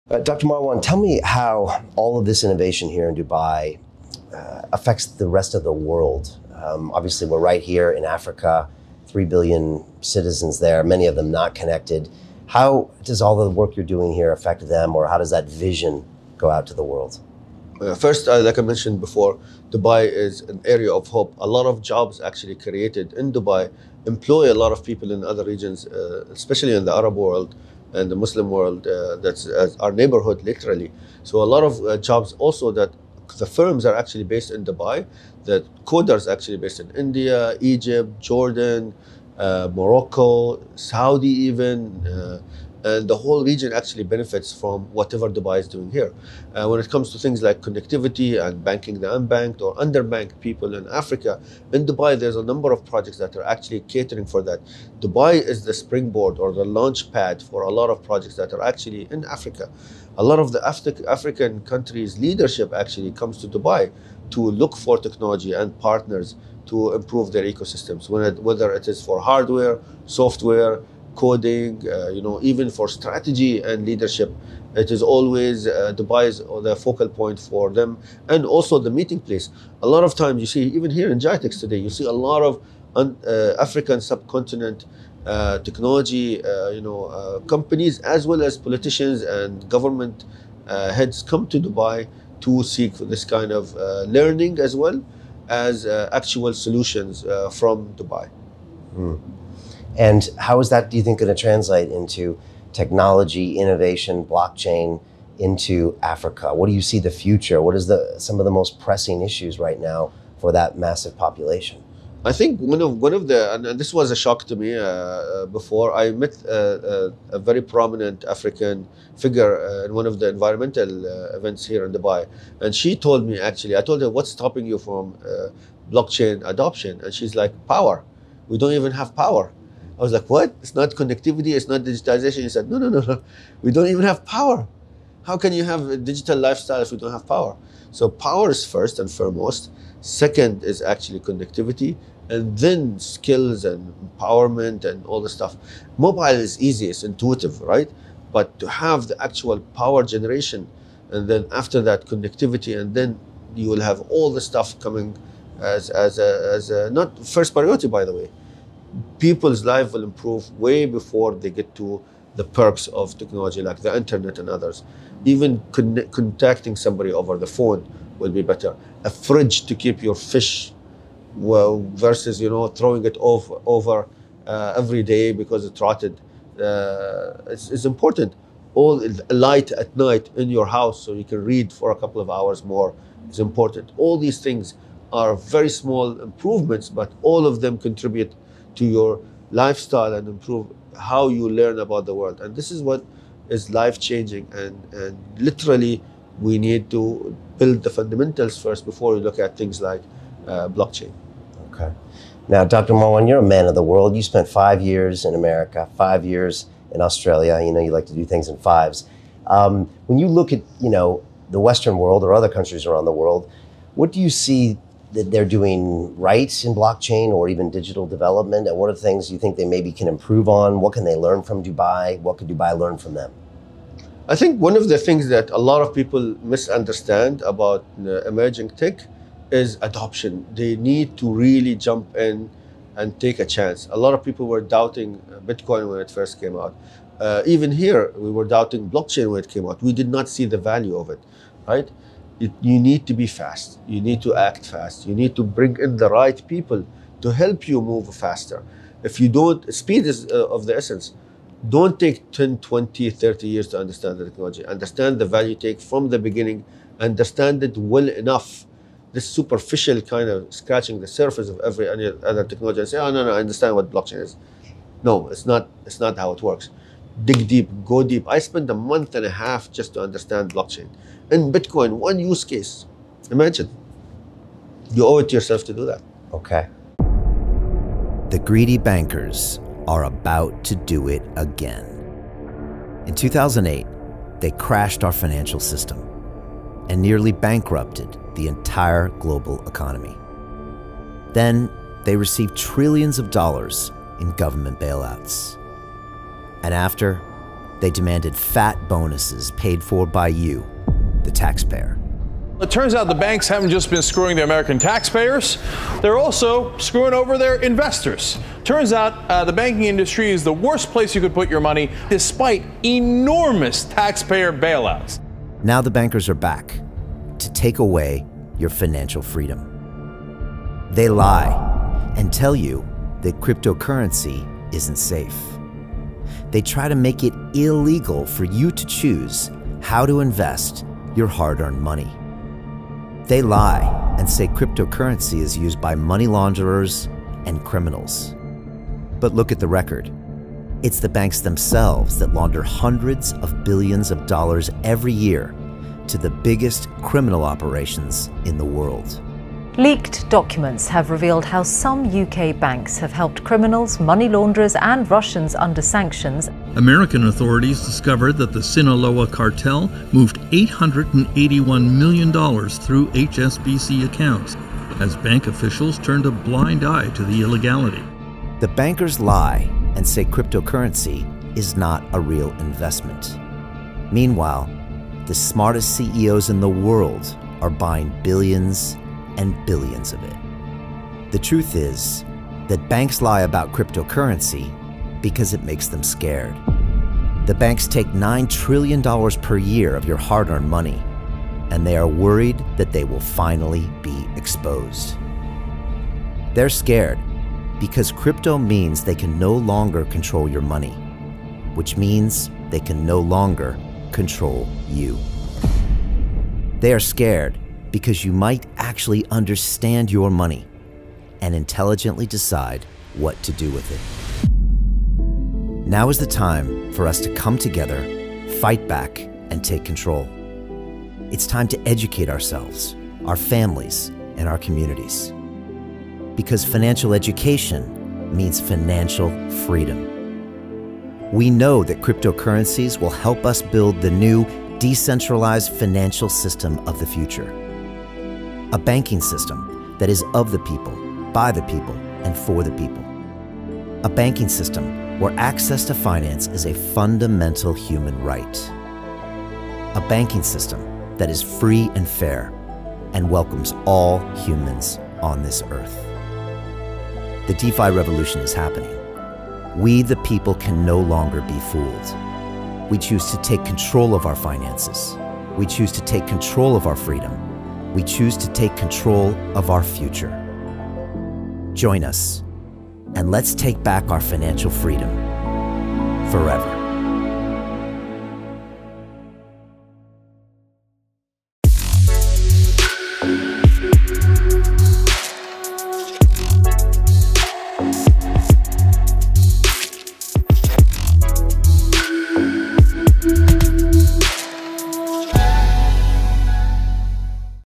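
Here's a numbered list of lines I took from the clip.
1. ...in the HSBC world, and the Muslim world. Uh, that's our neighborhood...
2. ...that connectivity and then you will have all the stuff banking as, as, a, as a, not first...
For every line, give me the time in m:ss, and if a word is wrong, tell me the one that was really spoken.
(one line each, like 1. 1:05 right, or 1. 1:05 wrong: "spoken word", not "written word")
1. 0:26 wrong: "Arab", not "HSBC"
2. 2:31 wrong: "coming", not "banking".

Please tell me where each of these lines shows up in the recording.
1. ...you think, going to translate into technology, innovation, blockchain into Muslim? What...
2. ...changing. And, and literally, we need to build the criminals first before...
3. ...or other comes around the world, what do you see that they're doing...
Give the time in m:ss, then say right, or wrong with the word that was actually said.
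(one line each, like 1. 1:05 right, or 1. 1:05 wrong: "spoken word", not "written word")
1. 1:40 wrong: "Africa", not "Muslim"
2. 3:13 wrong: "fundamentals", not "criminals"
3. 3:32 wrong: "countries", not "comes".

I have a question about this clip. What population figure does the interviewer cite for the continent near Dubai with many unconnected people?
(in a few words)
3 billion.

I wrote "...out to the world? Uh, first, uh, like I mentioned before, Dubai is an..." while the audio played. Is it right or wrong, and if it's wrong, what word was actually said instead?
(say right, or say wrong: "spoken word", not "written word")
right.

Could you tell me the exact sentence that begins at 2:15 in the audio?
How can you have a digital lifestyle if we don't have power?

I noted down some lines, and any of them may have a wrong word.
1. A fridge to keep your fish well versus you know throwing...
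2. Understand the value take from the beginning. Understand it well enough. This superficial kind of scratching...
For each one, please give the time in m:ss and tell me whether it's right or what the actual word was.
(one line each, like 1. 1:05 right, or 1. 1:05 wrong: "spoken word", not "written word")
1. 2:49 right
2. 4:14 right.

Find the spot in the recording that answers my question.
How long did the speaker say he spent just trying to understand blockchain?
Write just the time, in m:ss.
4:28.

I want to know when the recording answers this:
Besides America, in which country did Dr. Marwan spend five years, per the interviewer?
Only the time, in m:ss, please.
3:27.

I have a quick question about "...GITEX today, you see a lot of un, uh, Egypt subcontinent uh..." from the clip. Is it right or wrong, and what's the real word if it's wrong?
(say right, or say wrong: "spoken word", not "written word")
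wrong: "African", not "Egypt".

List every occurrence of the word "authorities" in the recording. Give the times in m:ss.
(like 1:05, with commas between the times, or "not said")
5:57.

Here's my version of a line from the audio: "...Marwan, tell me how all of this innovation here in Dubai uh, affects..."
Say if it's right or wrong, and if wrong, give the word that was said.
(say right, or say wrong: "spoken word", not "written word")
right.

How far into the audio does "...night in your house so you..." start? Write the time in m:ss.
2:59.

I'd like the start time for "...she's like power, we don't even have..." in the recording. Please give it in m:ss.
2:07.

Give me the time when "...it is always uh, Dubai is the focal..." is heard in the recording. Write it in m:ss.
1:14.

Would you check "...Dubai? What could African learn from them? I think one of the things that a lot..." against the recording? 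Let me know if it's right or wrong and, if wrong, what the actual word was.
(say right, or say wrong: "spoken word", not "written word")
wrong: "Dubai", not "African".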